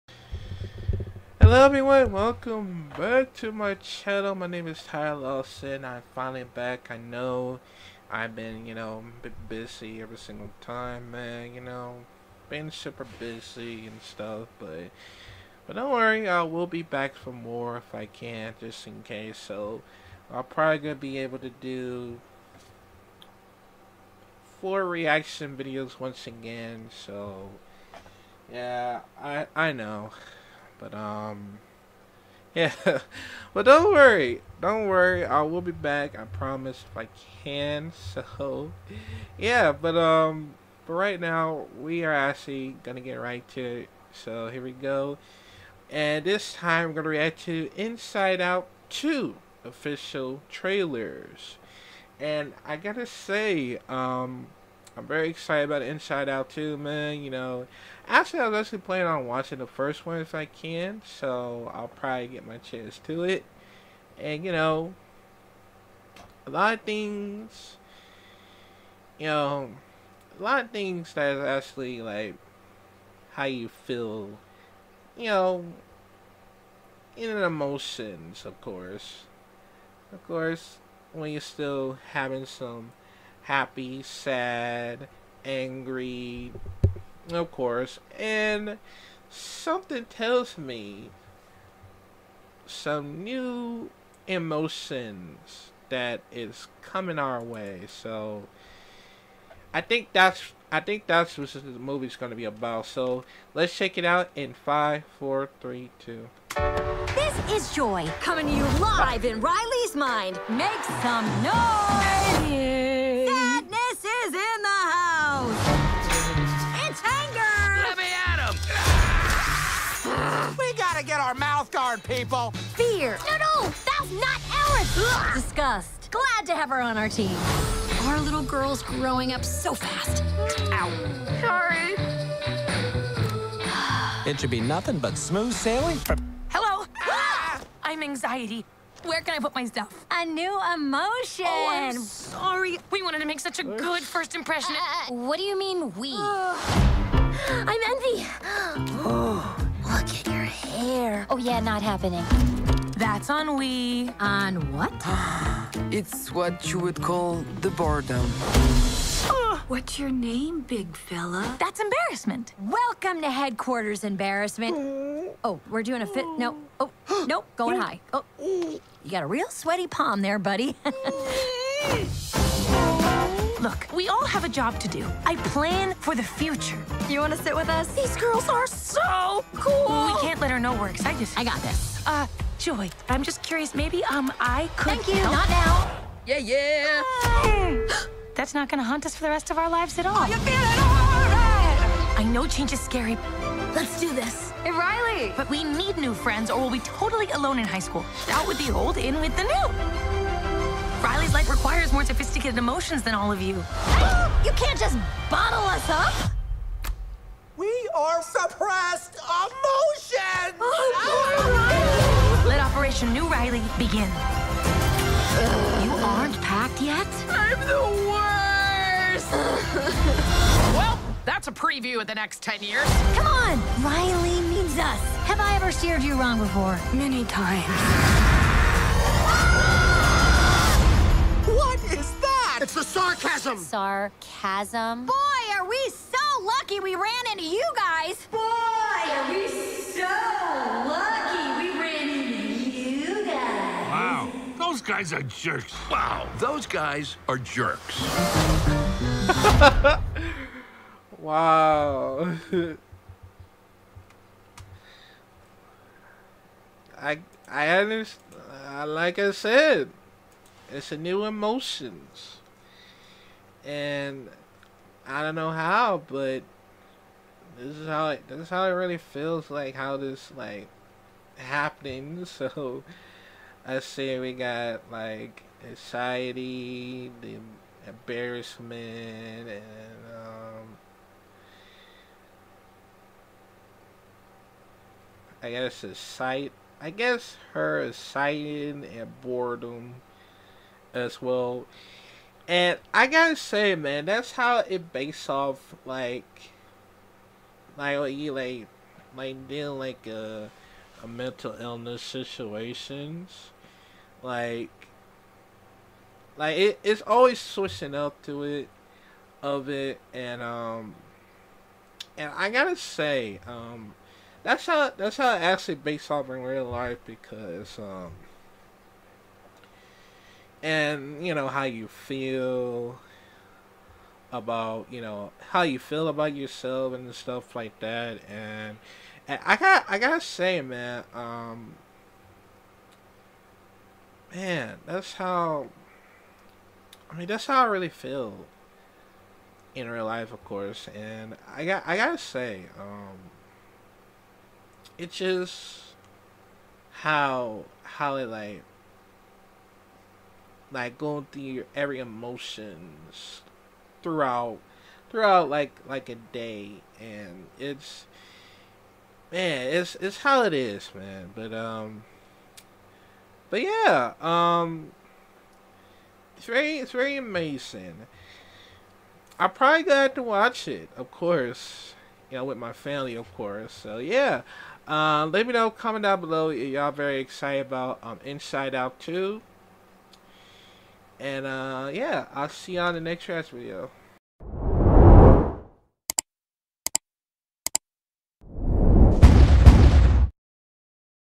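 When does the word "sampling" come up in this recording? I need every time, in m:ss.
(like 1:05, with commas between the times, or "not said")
not said.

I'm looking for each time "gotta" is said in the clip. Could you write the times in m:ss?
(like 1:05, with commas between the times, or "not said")
0:52, 4:53, 5:12, 5:29, 5:41.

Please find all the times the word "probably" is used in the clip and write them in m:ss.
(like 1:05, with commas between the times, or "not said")
0:20, 1:01, 6:09.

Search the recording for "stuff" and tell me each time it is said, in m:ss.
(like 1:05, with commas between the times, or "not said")
0:14, 2:19, 5:27.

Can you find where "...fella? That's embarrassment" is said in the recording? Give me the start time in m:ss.
2:40.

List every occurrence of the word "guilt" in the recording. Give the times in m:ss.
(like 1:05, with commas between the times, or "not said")
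not said.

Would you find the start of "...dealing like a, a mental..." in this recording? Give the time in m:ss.
4:59.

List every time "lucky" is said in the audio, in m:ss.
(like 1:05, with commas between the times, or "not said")
3:56, 4:00.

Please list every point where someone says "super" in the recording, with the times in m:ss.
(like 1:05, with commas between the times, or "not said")
0:12.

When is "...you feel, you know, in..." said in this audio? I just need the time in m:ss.
1:13.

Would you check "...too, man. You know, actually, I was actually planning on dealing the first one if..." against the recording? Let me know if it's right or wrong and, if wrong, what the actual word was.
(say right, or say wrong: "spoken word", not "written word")
wrong: "watching", not "dealing".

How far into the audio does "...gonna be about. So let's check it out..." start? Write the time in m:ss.
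1:42.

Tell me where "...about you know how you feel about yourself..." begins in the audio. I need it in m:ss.
5:24.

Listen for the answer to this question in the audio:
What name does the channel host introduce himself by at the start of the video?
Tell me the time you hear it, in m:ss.
0:04.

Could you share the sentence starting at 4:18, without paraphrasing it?
Uh, like I said, it's a new emotions and I don't know how, but this is how it.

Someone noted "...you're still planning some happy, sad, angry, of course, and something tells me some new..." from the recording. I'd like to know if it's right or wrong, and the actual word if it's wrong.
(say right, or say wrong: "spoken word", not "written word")
wrong: "having", not "planning".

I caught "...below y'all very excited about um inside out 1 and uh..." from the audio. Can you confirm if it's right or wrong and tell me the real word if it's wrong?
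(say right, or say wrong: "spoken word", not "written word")
wrong: "2", not "1".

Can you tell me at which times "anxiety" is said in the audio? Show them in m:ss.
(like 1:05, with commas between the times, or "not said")
2:18, 4:35.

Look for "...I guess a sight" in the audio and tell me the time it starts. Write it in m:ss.
4:45.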